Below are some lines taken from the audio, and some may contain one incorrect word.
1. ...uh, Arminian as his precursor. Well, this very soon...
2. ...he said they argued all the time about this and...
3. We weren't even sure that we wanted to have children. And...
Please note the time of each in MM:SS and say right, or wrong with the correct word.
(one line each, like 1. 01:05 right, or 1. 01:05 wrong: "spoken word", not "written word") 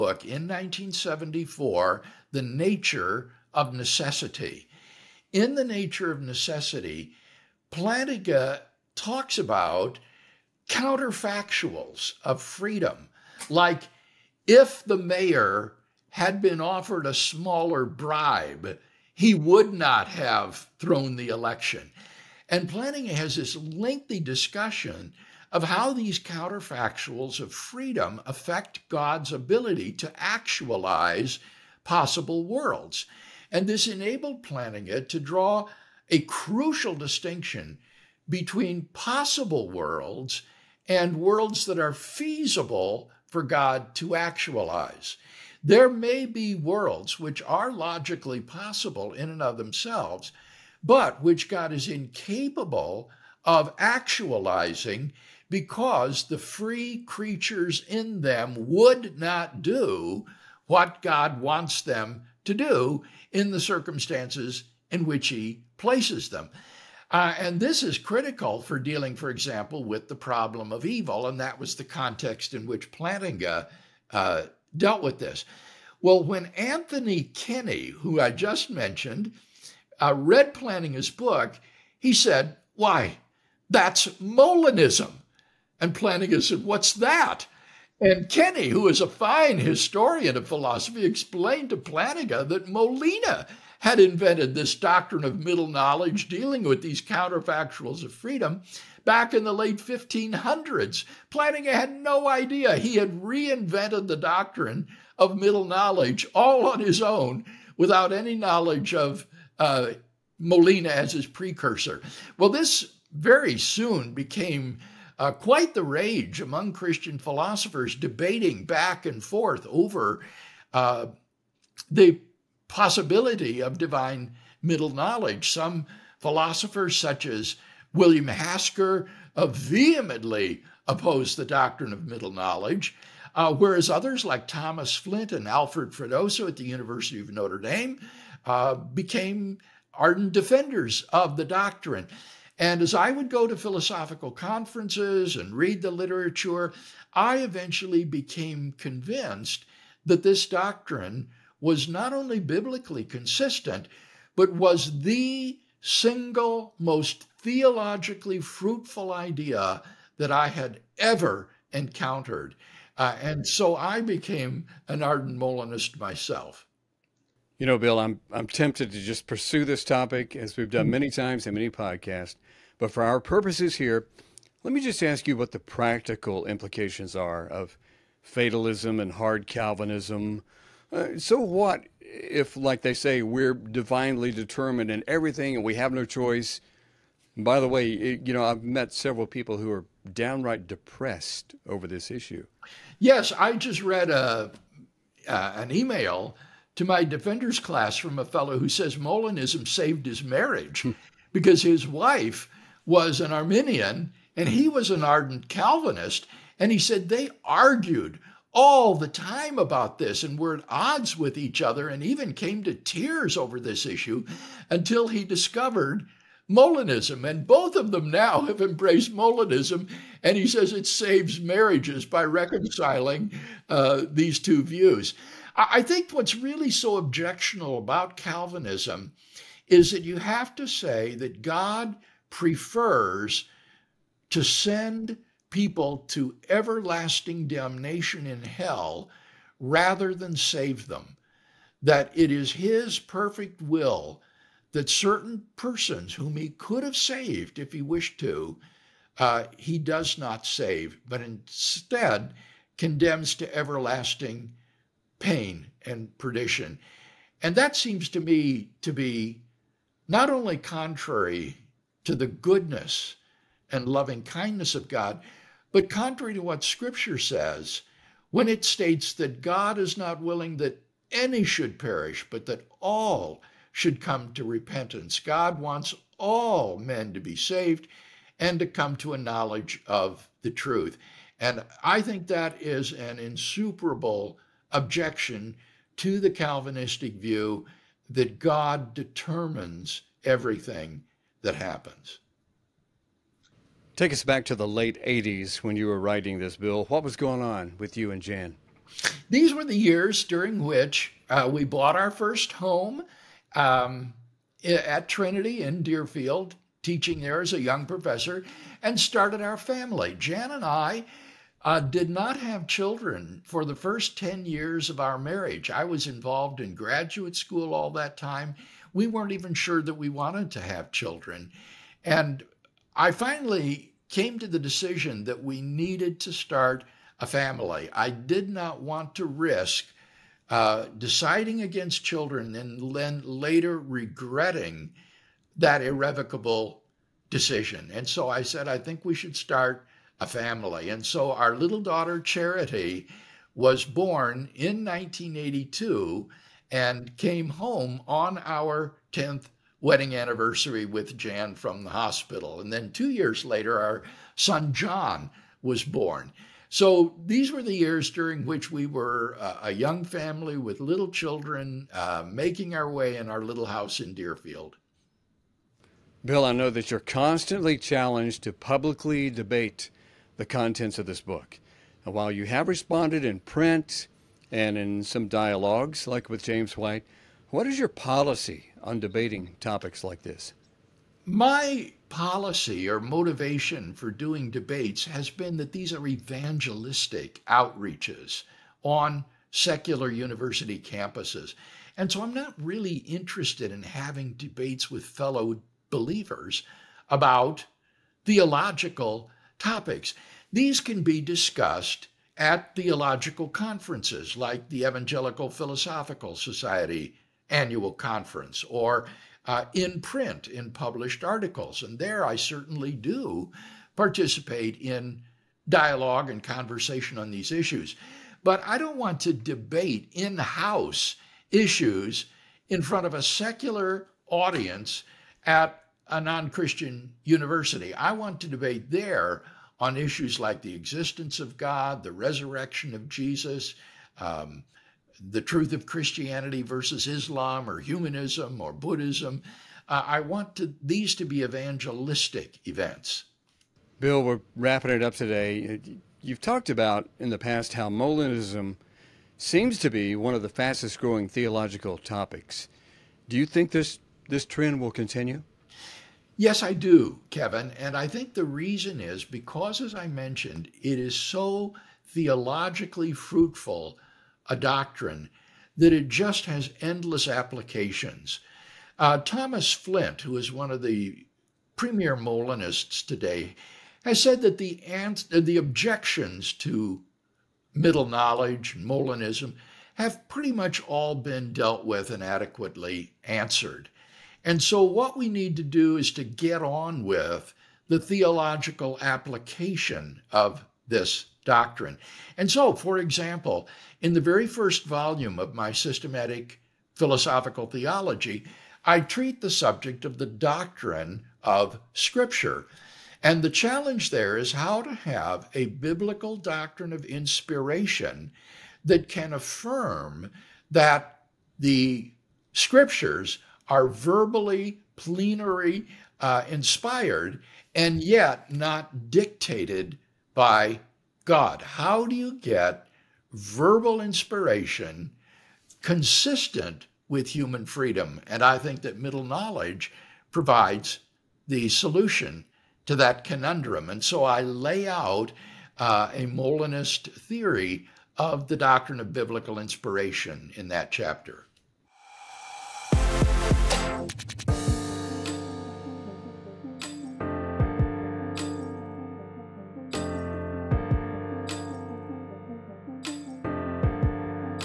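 1. 01:49 wrong: "Molina", not "Arminian"
2. 03:26 right
3. 05:18 right.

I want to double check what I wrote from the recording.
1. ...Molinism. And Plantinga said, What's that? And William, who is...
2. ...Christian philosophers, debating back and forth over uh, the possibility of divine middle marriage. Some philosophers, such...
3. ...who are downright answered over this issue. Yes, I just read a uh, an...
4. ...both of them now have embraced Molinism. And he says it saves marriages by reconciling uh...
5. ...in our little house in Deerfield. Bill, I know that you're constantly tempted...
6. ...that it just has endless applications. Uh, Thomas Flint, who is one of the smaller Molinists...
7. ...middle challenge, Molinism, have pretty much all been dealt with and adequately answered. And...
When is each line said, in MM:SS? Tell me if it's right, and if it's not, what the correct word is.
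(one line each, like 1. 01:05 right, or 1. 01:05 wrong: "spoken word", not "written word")
1. 01:24 wrong: "Kenny", not "William"
2. 01:56 wrong: "knowledge", not "marriage"
3. 03:09 wrong: "depressed", not "answered"
4. 03:37 right
5. 06:03 wrong: "challenged", not "tempted"
6. 07:45 wrong: "premier", not "smaller"
7. 07:57 wrong: "knowledge", not "challenge".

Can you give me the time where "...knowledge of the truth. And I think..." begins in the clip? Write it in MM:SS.
04:39.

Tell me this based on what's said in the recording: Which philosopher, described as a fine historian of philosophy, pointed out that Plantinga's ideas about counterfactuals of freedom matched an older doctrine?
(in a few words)
Anthony Kenny.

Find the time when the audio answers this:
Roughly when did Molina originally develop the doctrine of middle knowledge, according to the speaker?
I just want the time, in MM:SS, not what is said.
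01:39.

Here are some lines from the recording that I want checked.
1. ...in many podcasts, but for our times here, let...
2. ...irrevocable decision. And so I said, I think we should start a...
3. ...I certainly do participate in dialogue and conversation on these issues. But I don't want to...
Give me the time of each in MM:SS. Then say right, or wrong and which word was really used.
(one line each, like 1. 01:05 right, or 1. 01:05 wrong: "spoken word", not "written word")
1. 02:51 wrong: "purposes", not "times"
2. 05:35 right
3. 06:52 right.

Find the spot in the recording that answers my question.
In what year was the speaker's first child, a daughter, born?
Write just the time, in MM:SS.
05:44.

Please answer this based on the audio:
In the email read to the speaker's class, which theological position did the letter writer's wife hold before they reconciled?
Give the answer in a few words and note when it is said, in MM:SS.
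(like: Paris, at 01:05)
Arminian, at 03:23.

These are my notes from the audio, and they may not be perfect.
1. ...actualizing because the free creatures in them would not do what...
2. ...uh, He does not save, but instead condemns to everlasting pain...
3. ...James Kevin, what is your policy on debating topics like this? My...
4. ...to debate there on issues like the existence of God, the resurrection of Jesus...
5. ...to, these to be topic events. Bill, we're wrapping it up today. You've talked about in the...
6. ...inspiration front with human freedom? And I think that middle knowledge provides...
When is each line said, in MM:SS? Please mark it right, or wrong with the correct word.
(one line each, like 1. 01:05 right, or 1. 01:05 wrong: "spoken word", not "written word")
1. 00:53 right
2. 04:09 right
3. 06:16 wrong: "White", not "Kevin"
4. 07:08 right
5. 07:20 wrong: "evangelistic", not "topic"
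6. 08:43 wrong: "consistent", not "front".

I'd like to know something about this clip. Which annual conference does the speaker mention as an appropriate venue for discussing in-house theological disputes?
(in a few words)
Evangelical Philosophical Society.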